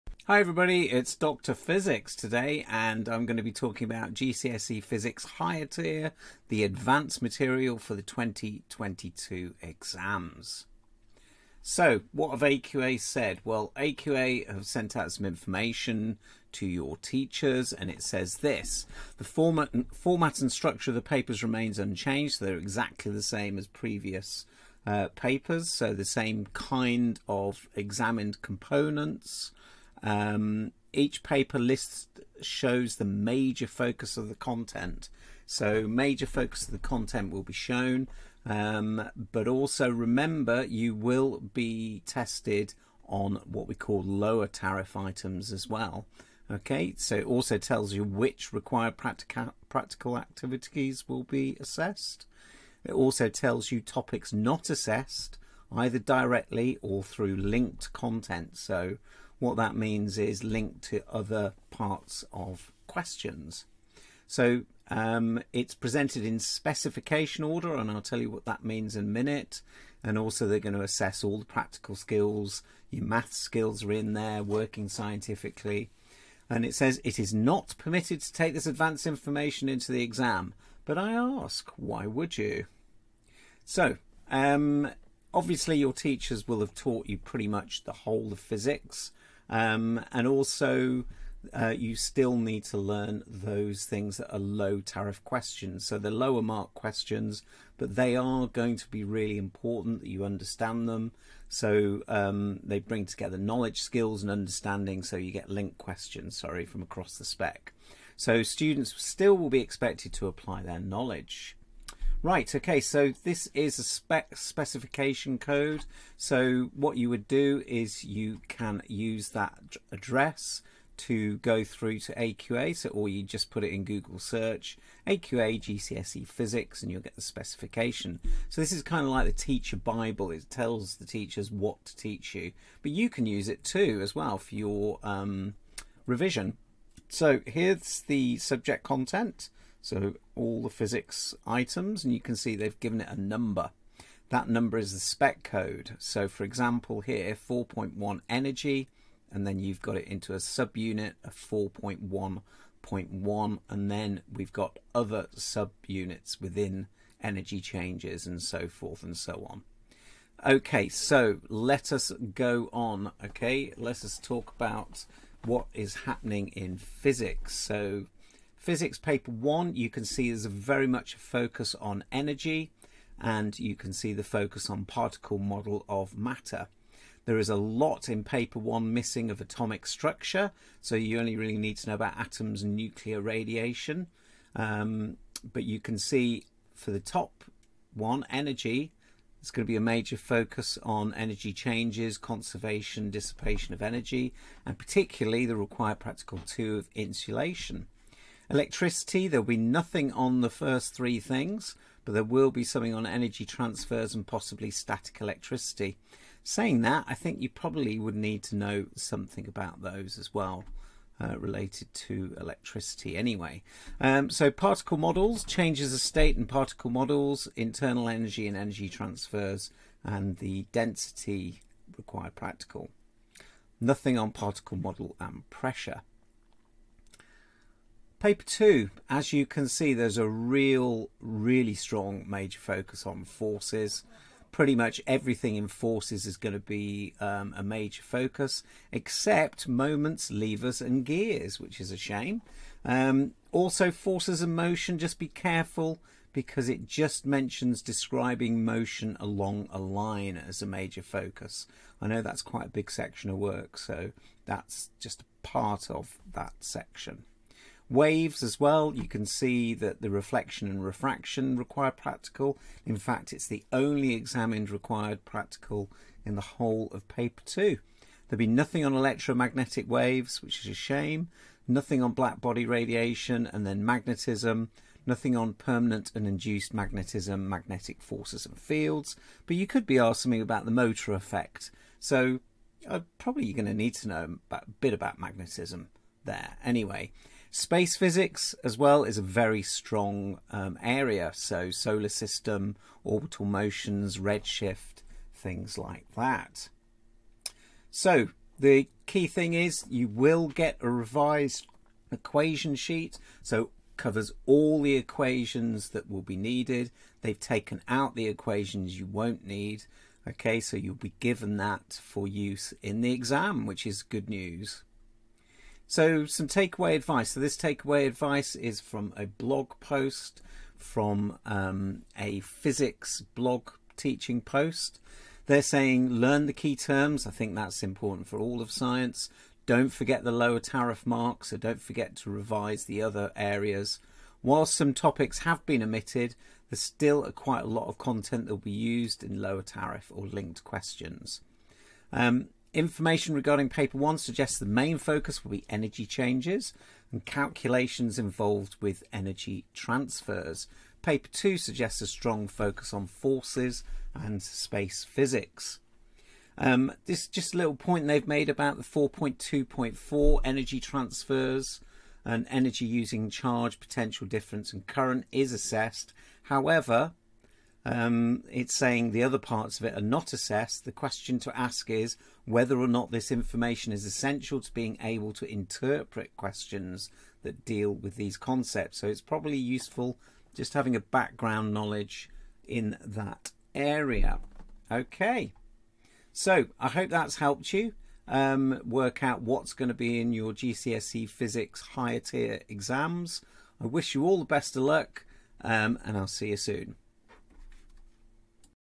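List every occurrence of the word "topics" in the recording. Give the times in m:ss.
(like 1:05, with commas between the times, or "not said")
0:53, 5:34.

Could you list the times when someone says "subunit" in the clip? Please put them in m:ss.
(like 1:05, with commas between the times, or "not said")
2:30, 2:35.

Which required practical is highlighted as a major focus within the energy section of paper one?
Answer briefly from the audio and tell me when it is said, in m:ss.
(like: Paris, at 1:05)
insulation, at 3:16.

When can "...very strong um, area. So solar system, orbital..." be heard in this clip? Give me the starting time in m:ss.
4:49.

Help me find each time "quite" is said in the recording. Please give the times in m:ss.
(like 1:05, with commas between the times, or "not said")
4:12, 5:37.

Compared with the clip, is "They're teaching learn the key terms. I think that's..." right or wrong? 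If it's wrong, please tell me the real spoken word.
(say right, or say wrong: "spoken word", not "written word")
wrong: "saying", not "teaching".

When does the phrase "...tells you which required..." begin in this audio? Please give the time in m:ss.
0:47.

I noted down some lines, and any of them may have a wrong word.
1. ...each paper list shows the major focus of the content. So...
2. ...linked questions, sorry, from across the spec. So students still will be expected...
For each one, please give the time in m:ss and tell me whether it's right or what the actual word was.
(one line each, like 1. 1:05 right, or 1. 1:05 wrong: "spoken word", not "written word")
1. 0:30 right
2. 1:45 right.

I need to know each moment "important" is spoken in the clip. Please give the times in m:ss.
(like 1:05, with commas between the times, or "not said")
1:39, 5:27.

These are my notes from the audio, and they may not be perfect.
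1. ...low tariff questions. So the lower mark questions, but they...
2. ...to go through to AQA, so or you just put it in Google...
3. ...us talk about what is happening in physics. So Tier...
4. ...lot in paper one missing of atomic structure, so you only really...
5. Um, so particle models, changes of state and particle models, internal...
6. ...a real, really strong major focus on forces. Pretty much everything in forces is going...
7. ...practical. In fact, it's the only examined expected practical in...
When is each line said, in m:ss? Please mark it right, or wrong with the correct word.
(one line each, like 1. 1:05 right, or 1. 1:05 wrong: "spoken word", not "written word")
1. 1:34 right
2. 2:00 right
3. 2:44 wrong: "Physics", not "Tier"
4. 2:57 right
5. 3:34 right
6. 3:50 right
7. 4:21 wrong: "required", not "expected".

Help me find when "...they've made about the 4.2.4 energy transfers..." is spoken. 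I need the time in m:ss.
5:58.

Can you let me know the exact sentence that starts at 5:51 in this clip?
Paper two suggests a strong focus on forces and space physics.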